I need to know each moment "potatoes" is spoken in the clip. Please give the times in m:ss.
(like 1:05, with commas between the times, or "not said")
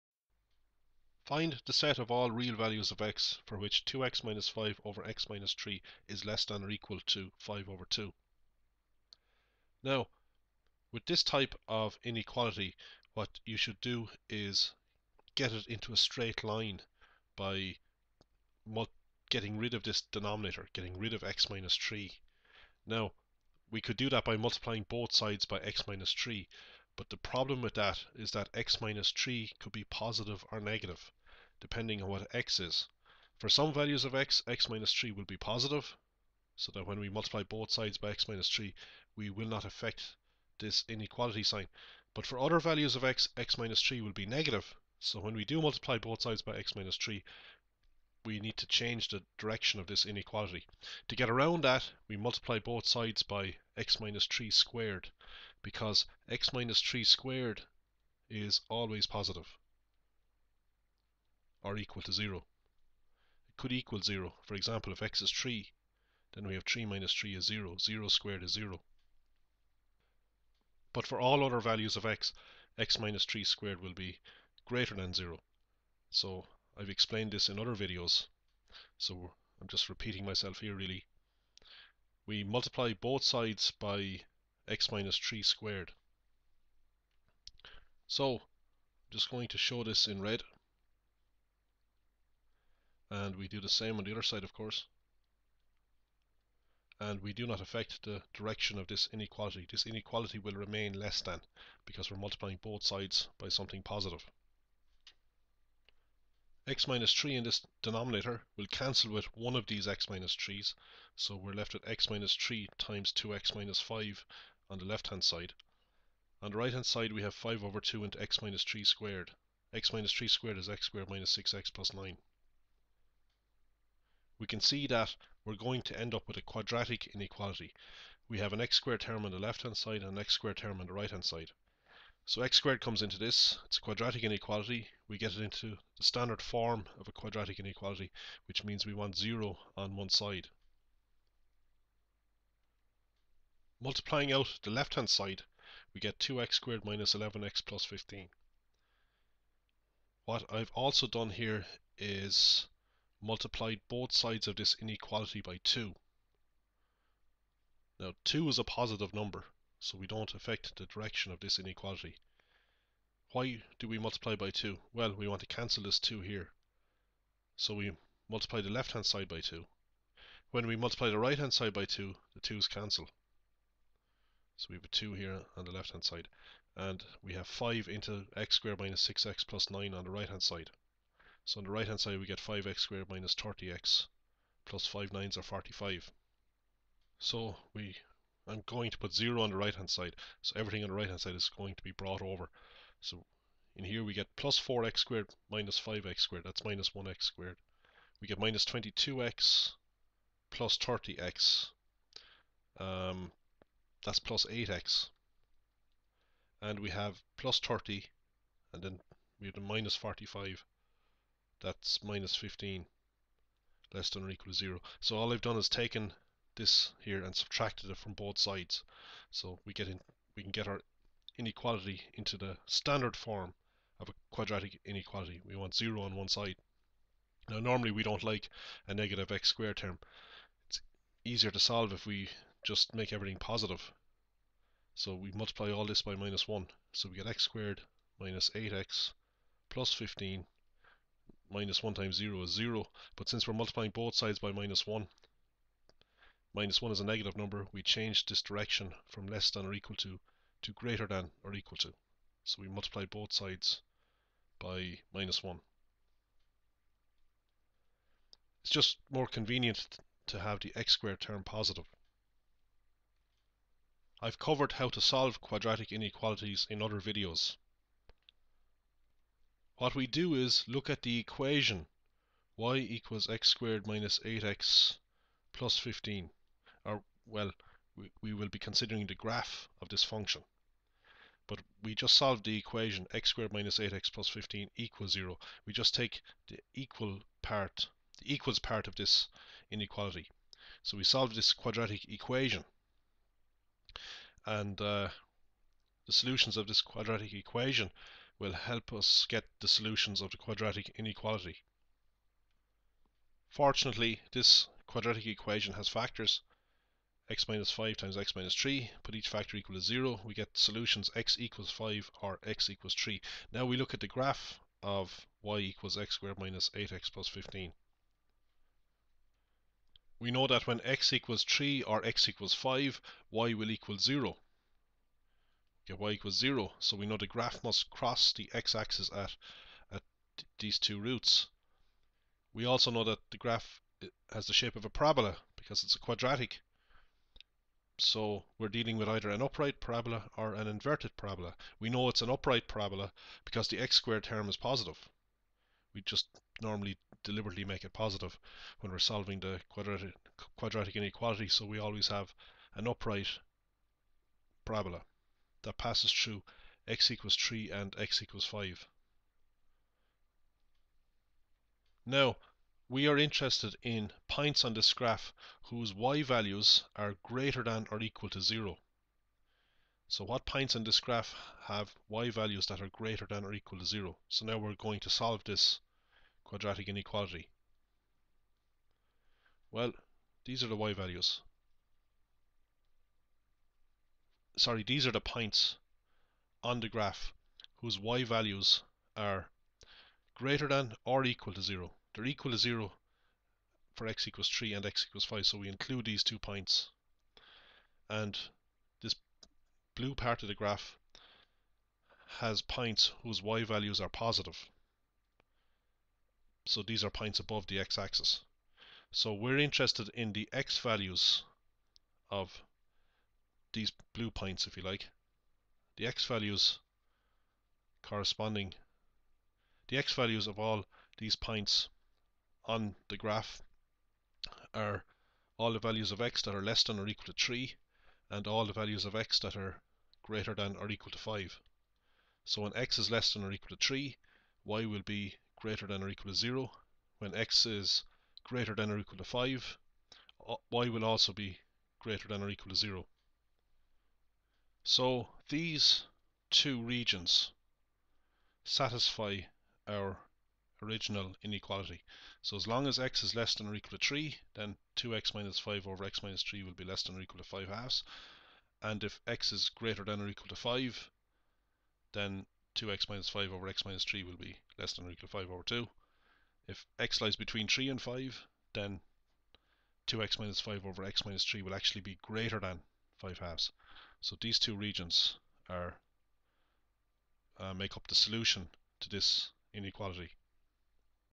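not said.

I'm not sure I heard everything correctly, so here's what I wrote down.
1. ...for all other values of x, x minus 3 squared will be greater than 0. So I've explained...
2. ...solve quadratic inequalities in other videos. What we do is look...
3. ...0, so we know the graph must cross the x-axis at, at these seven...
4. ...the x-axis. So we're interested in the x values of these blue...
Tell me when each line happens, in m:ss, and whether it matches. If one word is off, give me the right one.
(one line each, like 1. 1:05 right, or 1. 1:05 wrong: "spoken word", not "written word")
1. 1:11 right
2. 4:25 right
3. 5:26 wrong: "two", not "seven"
4. 6:47 right.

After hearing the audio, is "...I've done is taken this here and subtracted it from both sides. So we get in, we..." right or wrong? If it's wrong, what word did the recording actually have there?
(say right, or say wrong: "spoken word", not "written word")
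right.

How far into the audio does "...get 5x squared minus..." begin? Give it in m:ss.
3:02.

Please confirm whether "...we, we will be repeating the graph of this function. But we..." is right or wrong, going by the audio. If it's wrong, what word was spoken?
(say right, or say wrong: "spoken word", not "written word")
wrong: "considering", not "repeating".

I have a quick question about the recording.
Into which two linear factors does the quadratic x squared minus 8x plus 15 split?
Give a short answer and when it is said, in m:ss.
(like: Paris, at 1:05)
(x - 5)(x - 3), at 5:07.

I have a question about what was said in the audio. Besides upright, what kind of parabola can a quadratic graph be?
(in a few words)
Inverted parabola.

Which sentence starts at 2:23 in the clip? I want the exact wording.
Multiplying out the left-hand side, we get 2x squared minus 11x plus 15.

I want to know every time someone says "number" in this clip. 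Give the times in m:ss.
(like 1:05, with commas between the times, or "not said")
2:39, 4:07.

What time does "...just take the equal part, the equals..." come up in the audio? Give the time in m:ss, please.
4:45.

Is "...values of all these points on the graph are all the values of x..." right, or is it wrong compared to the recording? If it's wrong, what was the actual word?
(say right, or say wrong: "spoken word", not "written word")
right.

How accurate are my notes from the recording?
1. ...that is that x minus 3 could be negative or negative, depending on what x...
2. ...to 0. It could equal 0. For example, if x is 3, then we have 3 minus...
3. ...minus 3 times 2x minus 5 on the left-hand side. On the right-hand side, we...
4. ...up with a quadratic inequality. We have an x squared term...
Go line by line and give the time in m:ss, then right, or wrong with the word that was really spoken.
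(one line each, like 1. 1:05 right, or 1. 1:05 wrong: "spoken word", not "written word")
1. 0:27 wrong: "positive", not "negative"
2. 1:02 right
3. 1:52 right
4. 2:06 right.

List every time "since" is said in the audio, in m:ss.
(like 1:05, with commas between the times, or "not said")
4:03.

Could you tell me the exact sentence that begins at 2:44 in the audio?
Well, we want to cancel this 2 here.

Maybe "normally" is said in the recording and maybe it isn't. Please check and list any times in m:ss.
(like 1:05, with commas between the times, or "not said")
3:47, 5:46.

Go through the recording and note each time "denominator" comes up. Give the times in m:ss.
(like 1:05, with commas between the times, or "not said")
0:20, 1:47.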